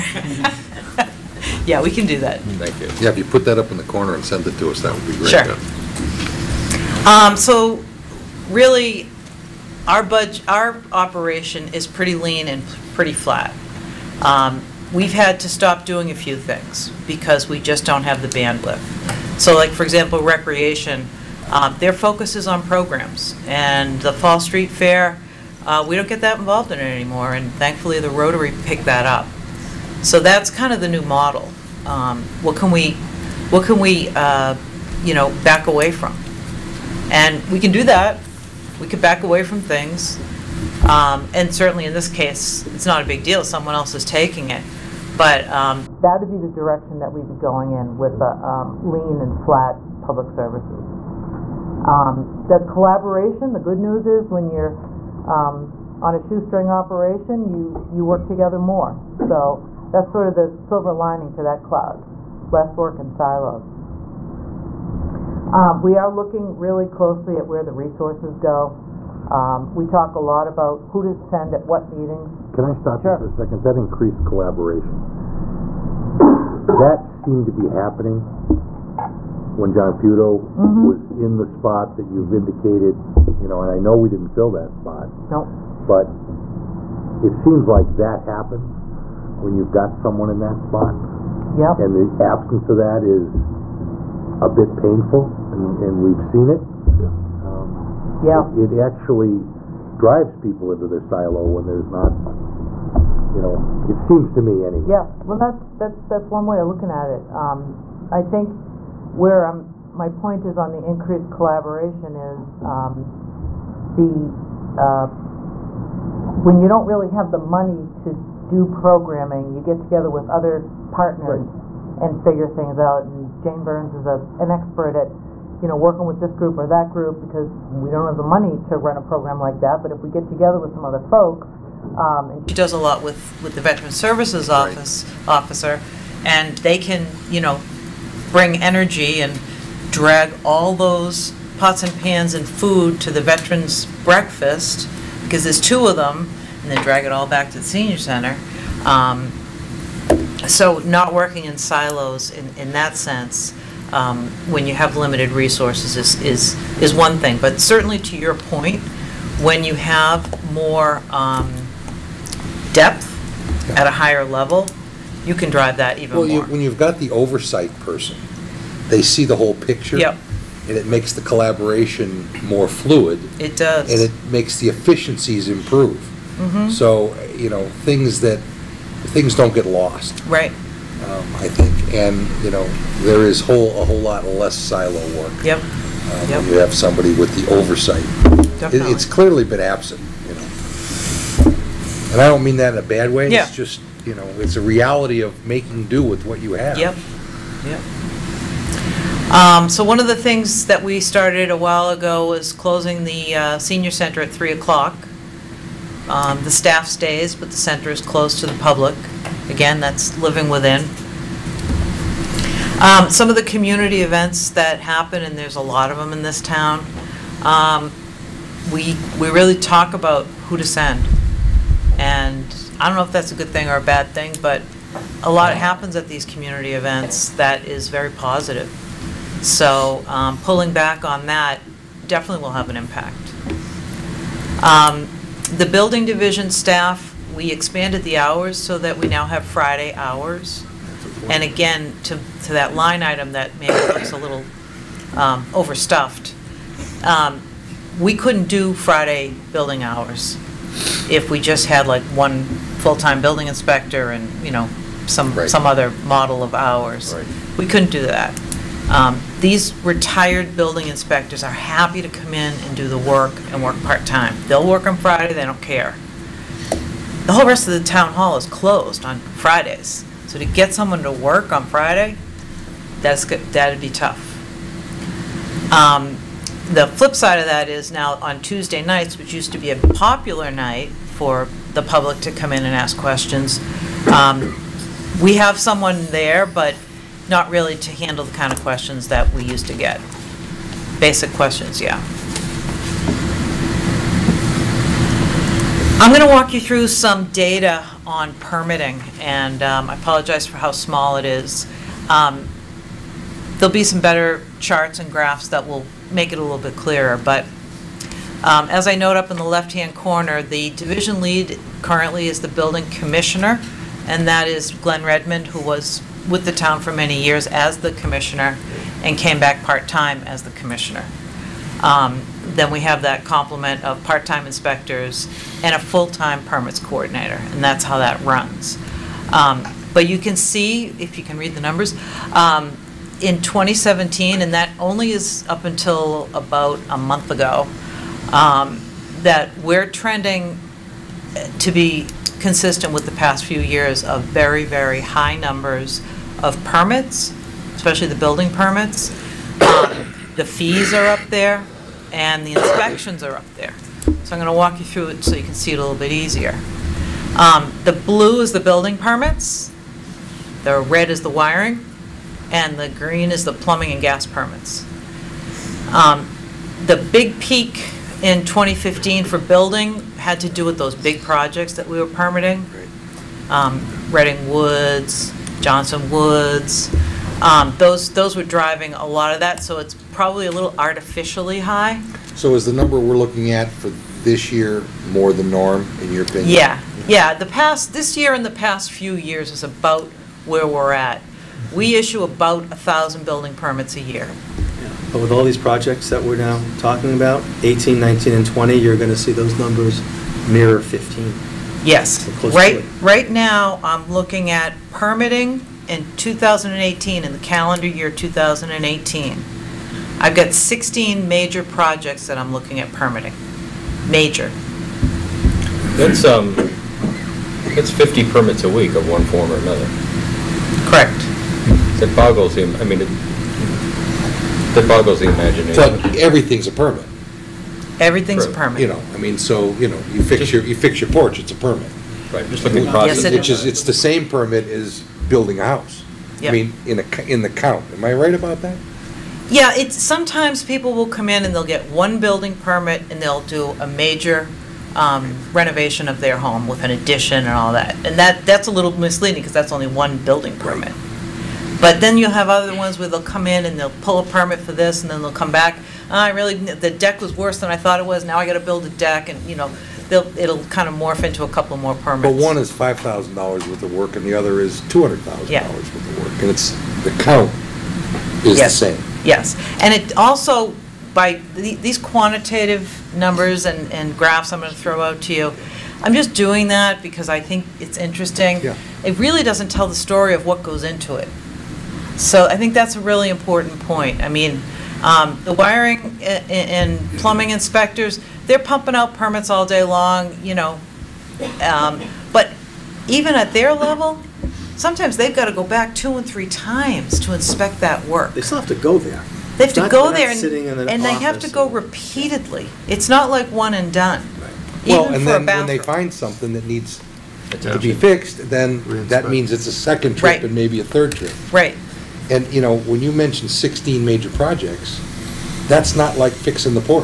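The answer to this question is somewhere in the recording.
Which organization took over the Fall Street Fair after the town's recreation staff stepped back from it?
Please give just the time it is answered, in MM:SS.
00:28.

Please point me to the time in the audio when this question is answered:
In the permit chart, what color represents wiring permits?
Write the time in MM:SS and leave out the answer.
06:00.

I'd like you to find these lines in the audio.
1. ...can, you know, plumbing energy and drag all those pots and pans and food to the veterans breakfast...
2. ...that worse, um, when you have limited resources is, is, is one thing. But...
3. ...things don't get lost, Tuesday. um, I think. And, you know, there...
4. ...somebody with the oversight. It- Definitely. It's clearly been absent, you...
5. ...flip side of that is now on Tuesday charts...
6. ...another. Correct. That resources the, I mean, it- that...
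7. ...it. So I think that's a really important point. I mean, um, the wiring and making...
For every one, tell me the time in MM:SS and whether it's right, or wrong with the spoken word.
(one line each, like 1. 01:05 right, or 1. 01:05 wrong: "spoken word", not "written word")
1. 02:16 wrong: "bring", not "plumbing"
2. 02:32 wrong: "sense", not "worse"
3. 02:58 wrong: "Right", not "Tuesday"
4. 03:06 right
5. 04:36 wrong: "nights", not "charts"
6. 06:59 wrong: "boggles", not "resources"
7. 08:01 wrong: "plumbing", not "making".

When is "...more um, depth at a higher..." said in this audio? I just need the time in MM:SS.
02:40.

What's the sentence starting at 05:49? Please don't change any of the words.
Um, the fees are up there, and the inspections are up there.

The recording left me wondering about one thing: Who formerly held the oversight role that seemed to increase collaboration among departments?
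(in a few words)
John Feudo.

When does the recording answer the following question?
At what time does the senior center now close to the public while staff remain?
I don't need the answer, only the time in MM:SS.
03:24.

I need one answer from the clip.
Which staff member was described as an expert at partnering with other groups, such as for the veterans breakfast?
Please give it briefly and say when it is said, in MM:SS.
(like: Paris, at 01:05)
Jane Burns, at 02:03.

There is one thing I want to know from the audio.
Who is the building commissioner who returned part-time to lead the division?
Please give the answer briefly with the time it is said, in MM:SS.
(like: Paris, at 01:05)
Glenn Redmond, at 05:14.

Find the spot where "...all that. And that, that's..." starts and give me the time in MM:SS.
07:27.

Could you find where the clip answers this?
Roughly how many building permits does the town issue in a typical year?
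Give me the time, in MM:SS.
06:32.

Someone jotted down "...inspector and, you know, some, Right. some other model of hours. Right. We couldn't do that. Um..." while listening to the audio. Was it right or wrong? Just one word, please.
right.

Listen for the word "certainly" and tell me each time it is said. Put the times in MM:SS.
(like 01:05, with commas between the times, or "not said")
00:41, 02:37.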